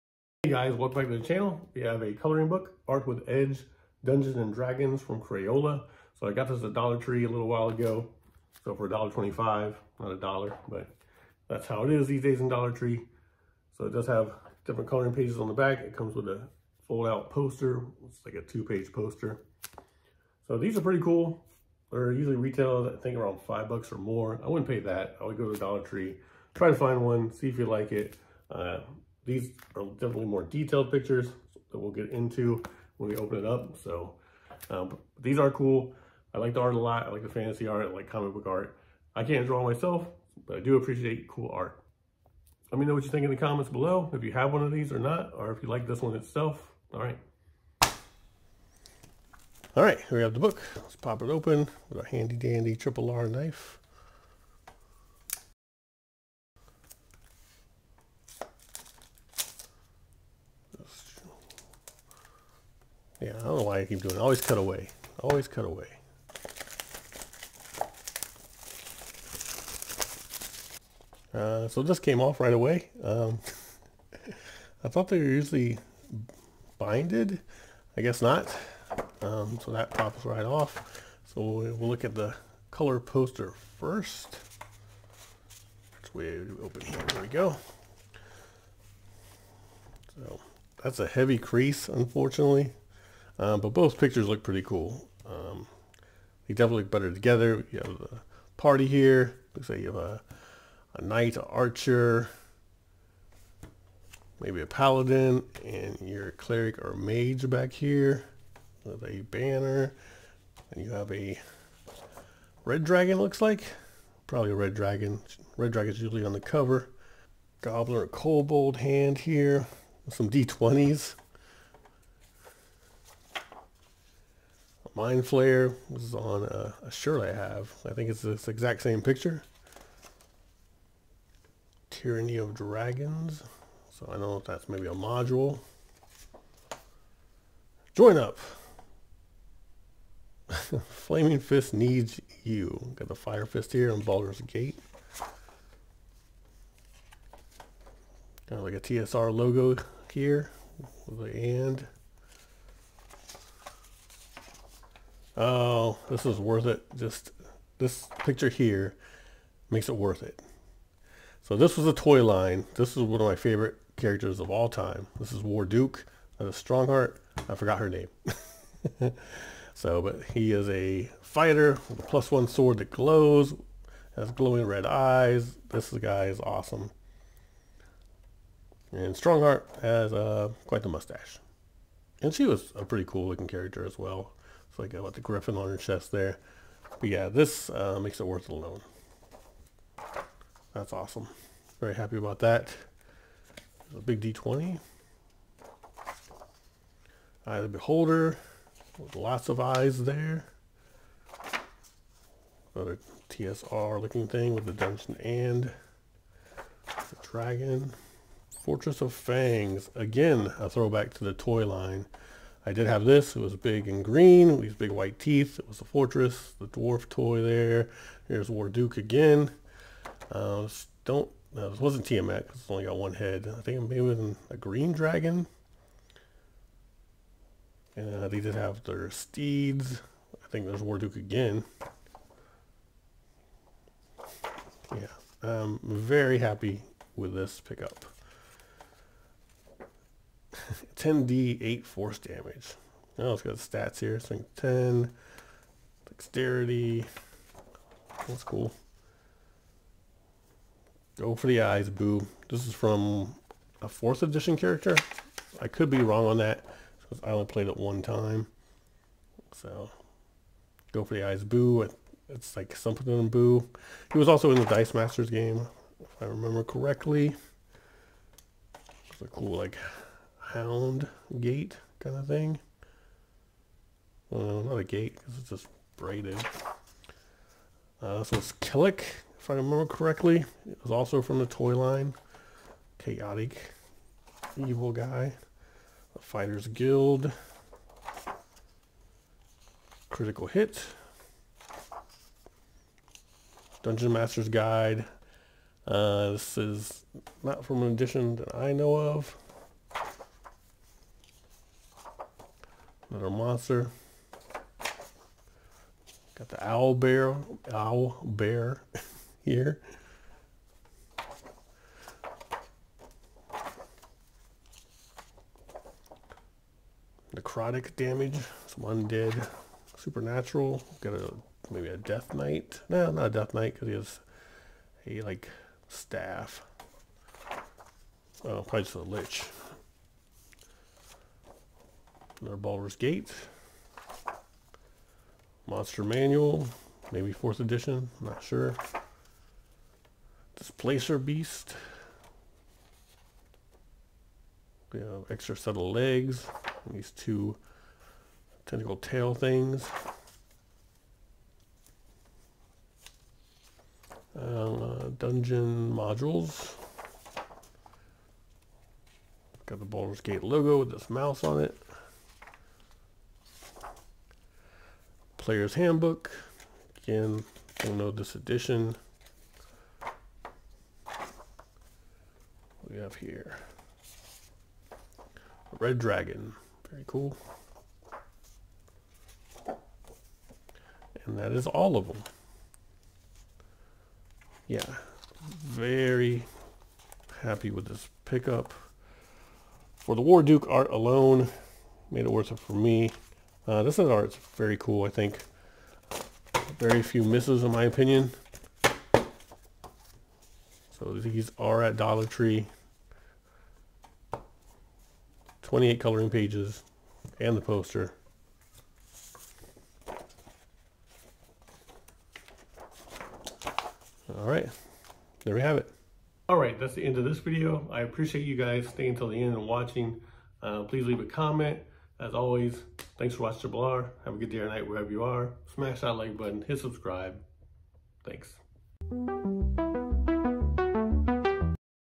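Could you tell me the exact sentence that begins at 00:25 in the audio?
I would go to Dollar Tree, try to find one, see if you like it.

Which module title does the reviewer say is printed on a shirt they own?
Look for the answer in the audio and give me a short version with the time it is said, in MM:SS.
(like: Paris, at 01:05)
Tyranny of Dragons, at 02:11.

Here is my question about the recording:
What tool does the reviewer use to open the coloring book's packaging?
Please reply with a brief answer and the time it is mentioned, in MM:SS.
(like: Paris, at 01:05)
triple R knife, at 00:52.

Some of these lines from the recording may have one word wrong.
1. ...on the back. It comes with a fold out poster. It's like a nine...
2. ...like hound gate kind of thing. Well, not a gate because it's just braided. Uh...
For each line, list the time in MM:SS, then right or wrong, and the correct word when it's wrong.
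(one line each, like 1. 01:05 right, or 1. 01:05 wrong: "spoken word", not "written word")
1. 00:15 wrong: "two", not "nine"
2. 04:29 right.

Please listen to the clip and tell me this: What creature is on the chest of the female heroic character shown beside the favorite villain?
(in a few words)
Griffin.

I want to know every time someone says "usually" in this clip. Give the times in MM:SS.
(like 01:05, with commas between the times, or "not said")
00:22, 01:15, 01:56.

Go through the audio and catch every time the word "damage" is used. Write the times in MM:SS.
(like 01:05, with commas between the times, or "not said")
04:02, 05:17.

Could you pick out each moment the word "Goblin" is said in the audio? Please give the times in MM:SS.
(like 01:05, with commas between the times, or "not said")
01:57.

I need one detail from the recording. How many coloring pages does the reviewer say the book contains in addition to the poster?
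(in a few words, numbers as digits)
28.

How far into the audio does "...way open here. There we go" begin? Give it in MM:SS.
01:26.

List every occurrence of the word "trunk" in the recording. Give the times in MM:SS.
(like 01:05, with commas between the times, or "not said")
not said.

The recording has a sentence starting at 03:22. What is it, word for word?
Another TSR looking thing with the Dungeon and the Dragon.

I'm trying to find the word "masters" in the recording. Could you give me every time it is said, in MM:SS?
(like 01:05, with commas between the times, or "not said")
04:24, 04:54.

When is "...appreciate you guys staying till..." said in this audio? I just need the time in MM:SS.
06:58.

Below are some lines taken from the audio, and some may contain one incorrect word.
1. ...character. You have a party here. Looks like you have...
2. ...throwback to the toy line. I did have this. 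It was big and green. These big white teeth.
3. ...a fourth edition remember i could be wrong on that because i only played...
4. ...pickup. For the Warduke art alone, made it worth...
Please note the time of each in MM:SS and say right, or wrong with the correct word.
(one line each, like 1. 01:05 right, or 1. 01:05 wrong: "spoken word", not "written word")
1. 01:37 wrong: "together", not "character"
2. 03:30 right
3. 04:13 wrong: "character", not "remember"
4. 06:28 right.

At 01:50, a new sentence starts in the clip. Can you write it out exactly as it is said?
And you have a red dragon, looks like.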